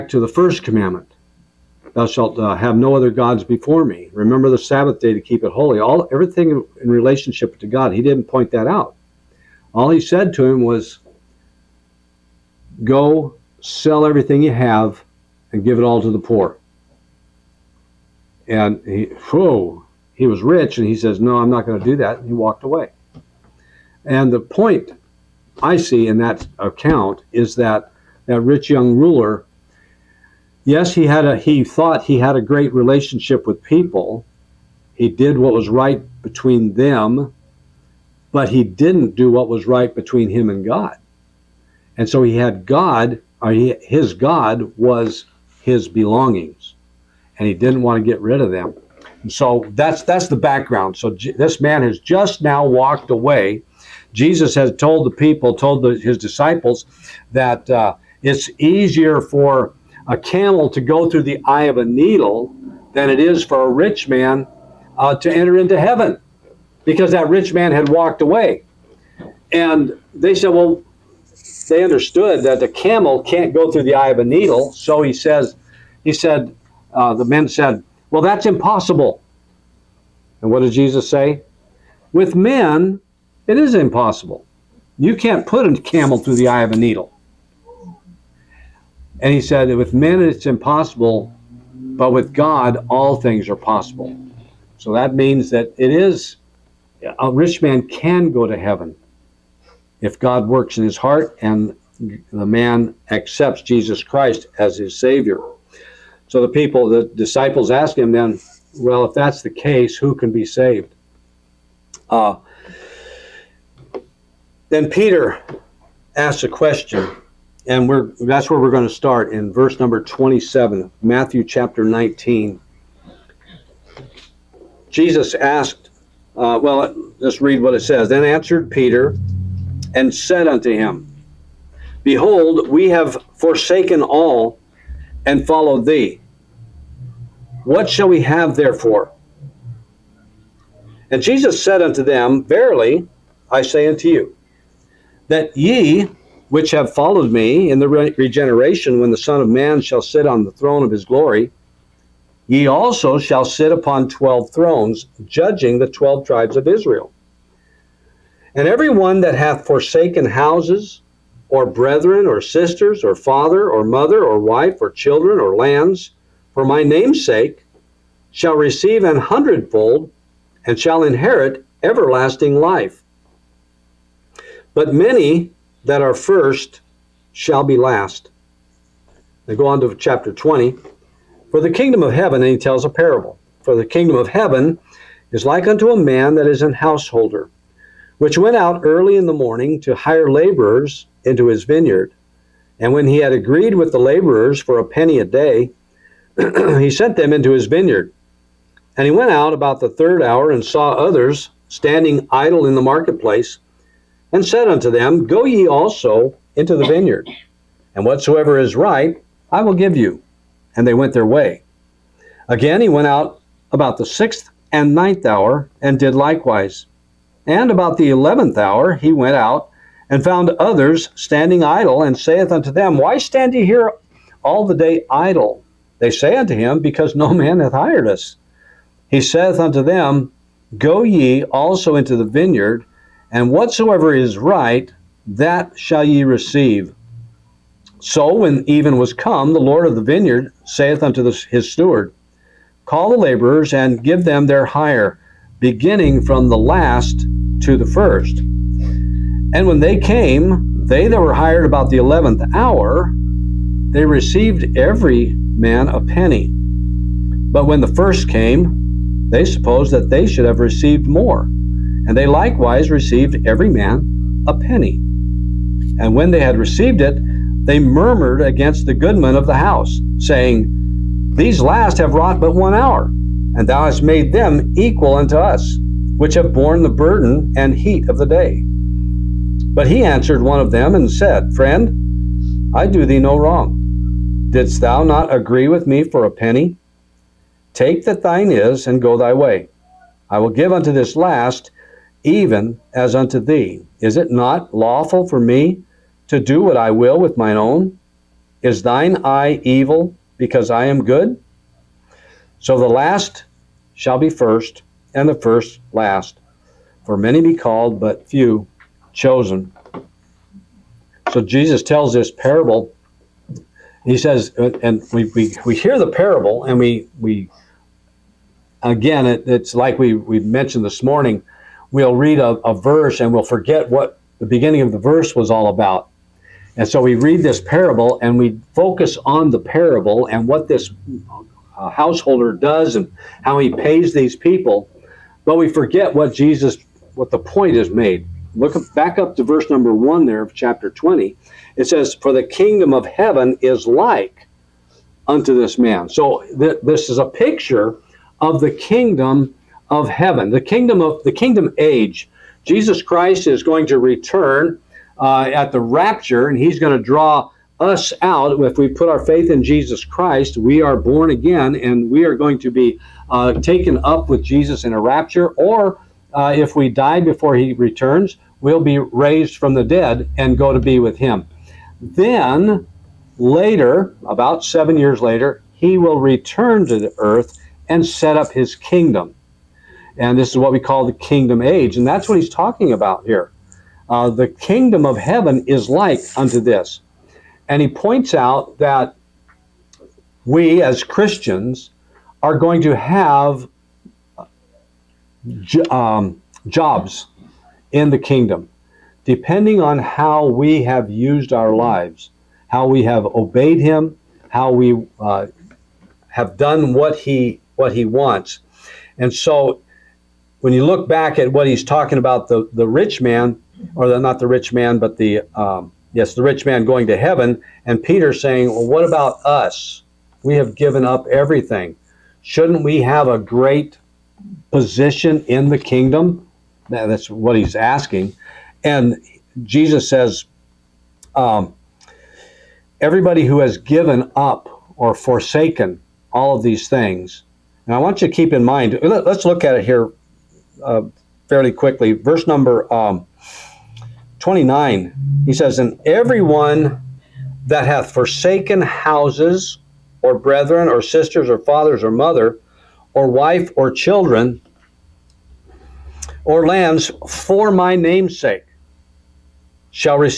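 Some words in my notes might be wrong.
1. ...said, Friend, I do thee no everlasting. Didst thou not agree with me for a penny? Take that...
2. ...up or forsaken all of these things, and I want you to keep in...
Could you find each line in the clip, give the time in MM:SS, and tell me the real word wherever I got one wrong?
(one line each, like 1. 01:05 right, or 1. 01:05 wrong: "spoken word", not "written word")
1. 04:41 wrong: "wrong", not "everlasting"
2. 07:14 right.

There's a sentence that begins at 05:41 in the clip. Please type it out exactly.
It says, For the kingdom of heaven is like unto this man.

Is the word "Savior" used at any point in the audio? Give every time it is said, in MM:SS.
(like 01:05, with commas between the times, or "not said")
01:44.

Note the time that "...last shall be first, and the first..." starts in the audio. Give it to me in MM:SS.
05:02.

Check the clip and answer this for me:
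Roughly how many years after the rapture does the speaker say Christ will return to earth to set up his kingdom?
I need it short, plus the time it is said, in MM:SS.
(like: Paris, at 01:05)
7, at 06:14.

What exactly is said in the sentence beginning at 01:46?
So the people, the disciples ask him then, well, if that's the case, who can be saved?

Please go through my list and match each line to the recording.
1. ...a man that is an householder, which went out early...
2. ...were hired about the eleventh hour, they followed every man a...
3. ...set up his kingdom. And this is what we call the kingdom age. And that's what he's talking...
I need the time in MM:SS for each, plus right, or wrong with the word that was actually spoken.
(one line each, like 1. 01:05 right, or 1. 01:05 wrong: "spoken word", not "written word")
1. 03:05 right
2. 04:11 wrong: "received", not "followed"
3. 06:18 right.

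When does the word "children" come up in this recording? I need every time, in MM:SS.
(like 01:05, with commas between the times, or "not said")
02:44, 07:33.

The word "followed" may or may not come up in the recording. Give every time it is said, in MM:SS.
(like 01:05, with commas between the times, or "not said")
02:15, 02:26.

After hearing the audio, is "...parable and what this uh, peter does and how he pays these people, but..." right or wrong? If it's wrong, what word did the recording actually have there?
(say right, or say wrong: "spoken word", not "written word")
wrong: "householder", not "peter".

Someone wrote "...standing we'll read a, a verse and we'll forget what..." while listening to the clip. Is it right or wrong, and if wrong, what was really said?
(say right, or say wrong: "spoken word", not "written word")
wrong: "morning", not "standing".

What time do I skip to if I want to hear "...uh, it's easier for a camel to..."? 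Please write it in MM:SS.
00:57.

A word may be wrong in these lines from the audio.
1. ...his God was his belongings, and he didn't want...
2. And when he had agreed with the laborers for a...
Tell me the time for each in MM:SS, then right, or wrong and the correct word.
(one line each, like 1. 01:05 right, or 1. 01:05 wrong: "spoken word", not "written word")
1. 00:43 right
2. 03:12 right.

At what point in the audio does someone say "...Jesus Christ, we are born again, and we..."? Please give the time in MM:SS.
05:59.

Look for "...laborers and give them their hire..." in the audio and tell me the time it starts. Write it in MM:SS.
04:03.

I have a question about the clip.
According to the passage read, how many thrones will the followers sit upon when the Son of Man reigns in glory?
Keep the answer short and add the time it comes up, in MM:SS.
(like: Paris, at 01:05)
12, at 02:34.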